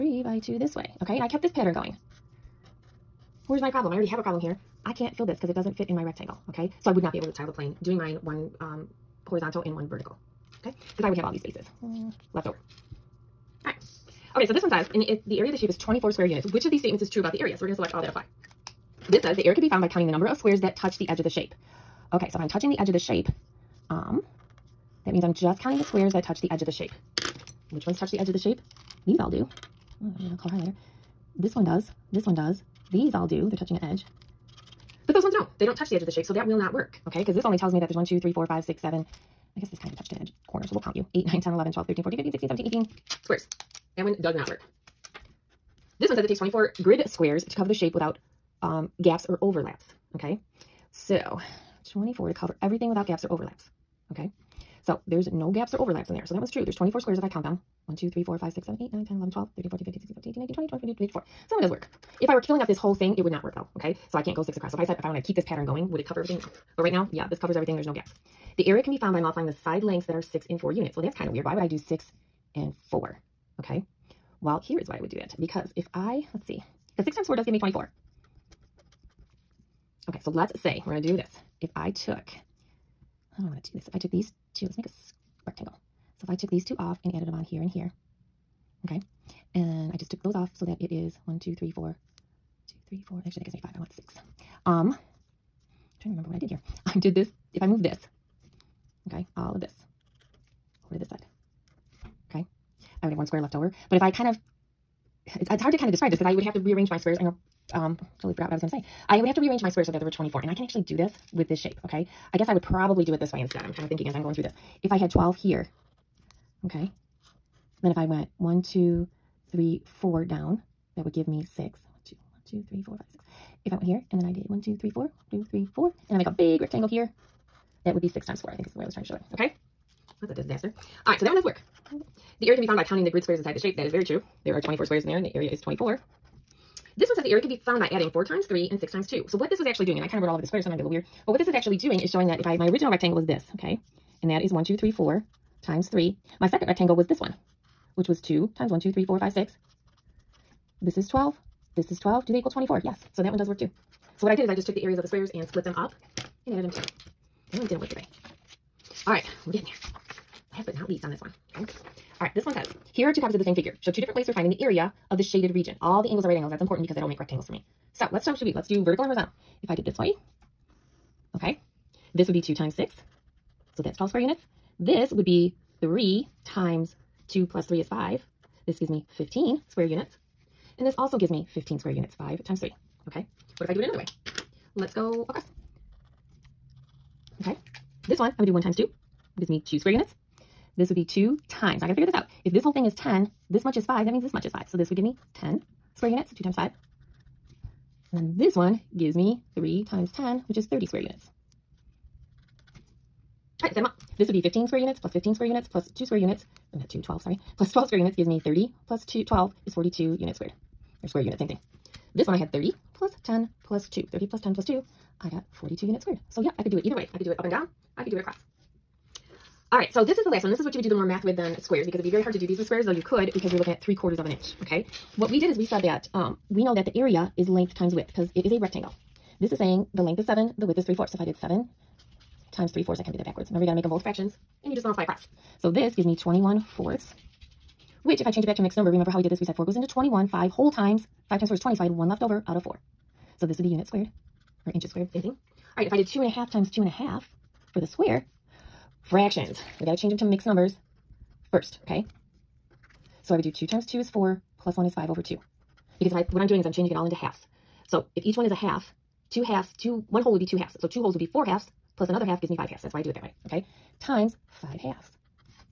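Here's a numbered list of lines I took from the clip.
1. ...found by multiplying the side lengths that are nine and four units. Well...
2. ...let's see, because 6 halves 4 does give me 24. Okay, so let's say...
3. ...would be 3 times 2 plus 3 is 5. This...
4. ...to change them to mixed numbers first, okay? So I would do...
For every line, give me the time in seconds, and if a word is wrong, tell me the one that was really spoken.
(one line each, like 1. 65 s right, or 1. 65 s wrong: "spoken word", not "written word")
1. 68 s wrong: "six", not "nine"
2. 76 s wrong: "times", not "halves"
3. 175 s right
4. 249 s right.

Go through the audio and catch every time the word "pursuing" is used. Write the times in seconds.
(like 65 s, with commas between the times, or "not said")
not said.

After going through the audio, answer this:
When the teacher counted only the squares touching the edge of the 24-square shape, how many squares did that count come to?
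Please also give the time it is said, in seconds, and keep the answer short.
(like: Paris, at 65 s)
18, at 42 s.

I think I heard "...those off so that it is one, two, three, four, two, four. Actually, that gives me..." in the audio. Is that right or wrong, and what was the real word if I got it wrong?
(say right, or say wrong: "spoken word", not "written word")
wrong: "three", not "two".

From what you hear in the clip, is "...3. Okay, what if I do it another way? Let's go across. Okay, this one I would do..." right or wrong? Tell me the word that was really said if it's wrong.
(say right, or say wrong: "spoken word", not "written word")
right.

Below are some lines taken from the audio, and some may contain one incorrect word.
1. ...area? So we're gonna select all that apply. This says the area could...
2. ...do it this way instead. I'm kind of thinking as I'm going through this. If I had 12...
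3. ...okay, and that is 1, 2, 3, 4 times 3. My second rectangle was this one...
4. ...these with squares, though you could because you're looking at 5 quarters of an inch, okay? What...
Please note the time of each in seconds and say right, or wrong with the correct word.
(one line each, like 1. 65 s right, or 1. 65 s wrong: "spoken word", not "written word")
1. 17 s right
2. 113 s right
3. 143 s right
4. 222 s wrong: "3", not "5".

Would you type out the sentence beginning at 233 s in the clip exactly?
Remember, you got to make them both fractions, and you just multiply across.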